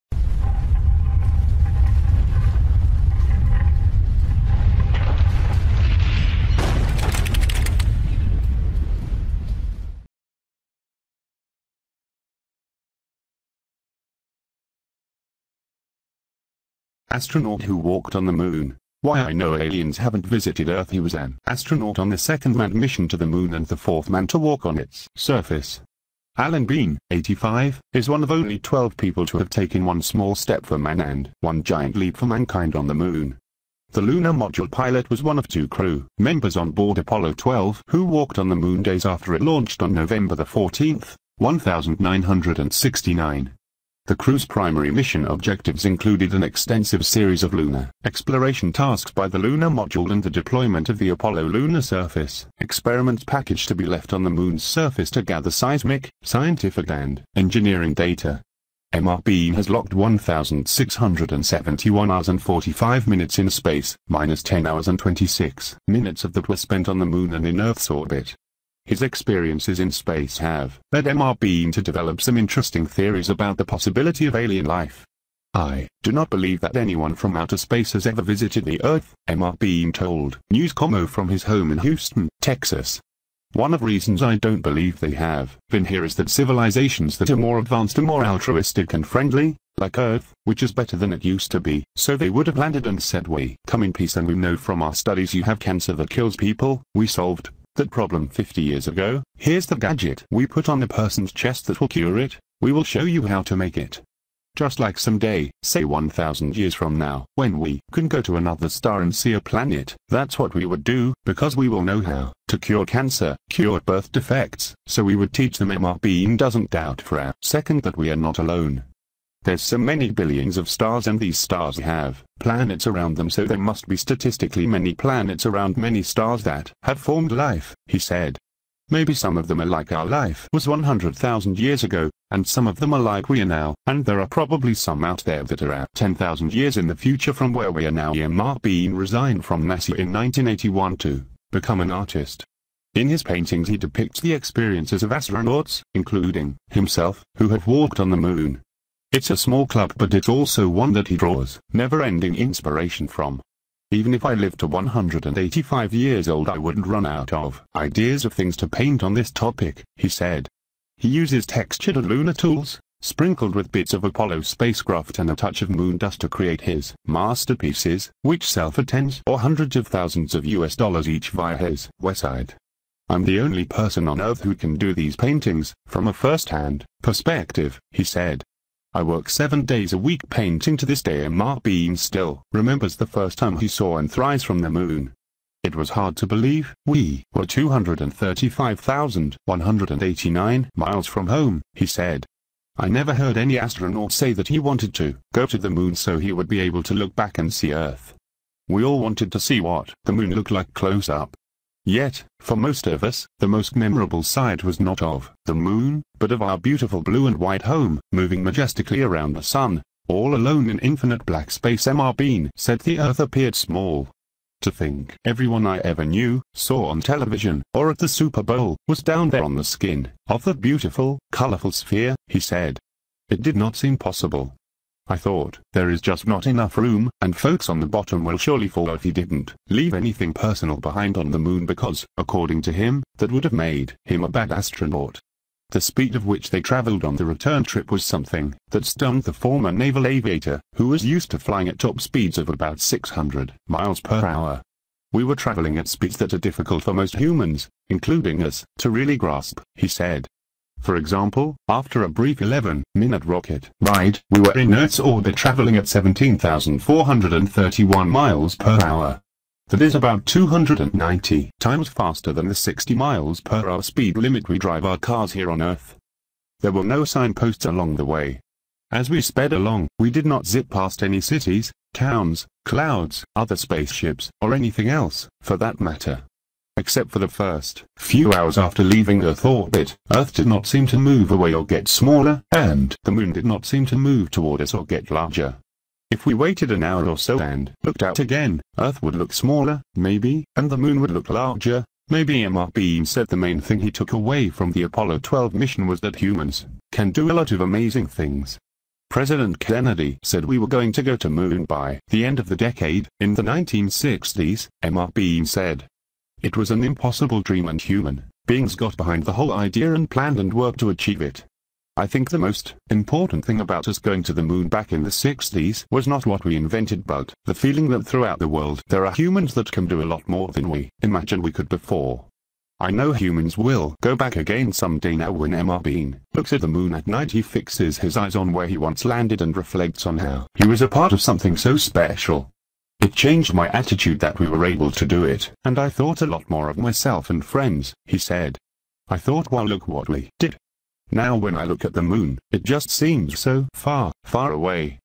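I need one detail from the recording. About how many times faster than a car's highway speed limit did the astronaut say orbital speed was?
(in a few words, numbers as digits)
290 times.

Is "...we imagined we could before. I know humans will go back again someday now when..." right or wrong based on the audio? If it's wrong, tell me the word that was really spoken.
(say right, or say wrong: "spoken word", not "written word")
right.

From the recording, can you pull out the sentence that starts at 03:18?
We all wanted to see what the moon looked like close up.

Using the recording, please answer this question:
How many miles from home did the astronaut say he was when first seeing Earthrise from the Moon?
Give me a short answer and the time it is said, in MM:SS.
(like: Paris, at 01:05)
235,189 miles, at 03:07.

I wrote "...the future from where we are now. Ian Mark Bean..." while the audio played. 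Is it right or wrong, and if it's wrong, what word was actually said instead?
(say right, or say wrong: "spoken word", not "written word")
right.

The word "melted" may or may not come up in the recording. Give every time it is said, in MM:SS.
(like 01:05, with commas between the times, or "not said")
not said.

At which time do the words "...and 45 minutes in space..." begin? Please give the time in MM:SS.
01:02.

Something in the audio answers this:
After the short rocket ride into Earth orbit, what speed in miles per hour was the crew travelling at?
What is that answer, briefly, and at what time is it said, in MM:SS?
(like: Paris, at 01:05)
17,431 miles per hour, at 04:15.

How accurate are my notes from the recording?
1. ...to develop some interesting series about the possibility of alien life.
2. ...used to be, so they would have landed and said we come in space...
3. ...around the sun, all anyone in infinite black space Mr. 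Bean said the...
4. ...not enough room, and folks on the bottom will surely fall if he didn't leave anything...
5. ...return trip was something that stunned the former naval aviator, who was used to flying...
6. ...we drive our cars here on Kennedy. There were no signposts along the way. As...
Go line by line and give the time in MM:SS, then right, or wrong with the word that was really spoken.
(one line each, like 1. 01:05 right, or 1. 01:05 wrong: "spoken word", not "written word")
1. 01:11 wrong: "theories", not "series"
2. 01:31 wrong: "peace", not "space"
3. 03:29 wrong: "alone", not "anyone"
4. 03:46 right
5. 03:57 right
6. 04:24 wrong: "Earth", not "Kennedy".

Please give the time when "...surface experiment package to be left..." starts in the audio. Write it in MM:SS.
00:51.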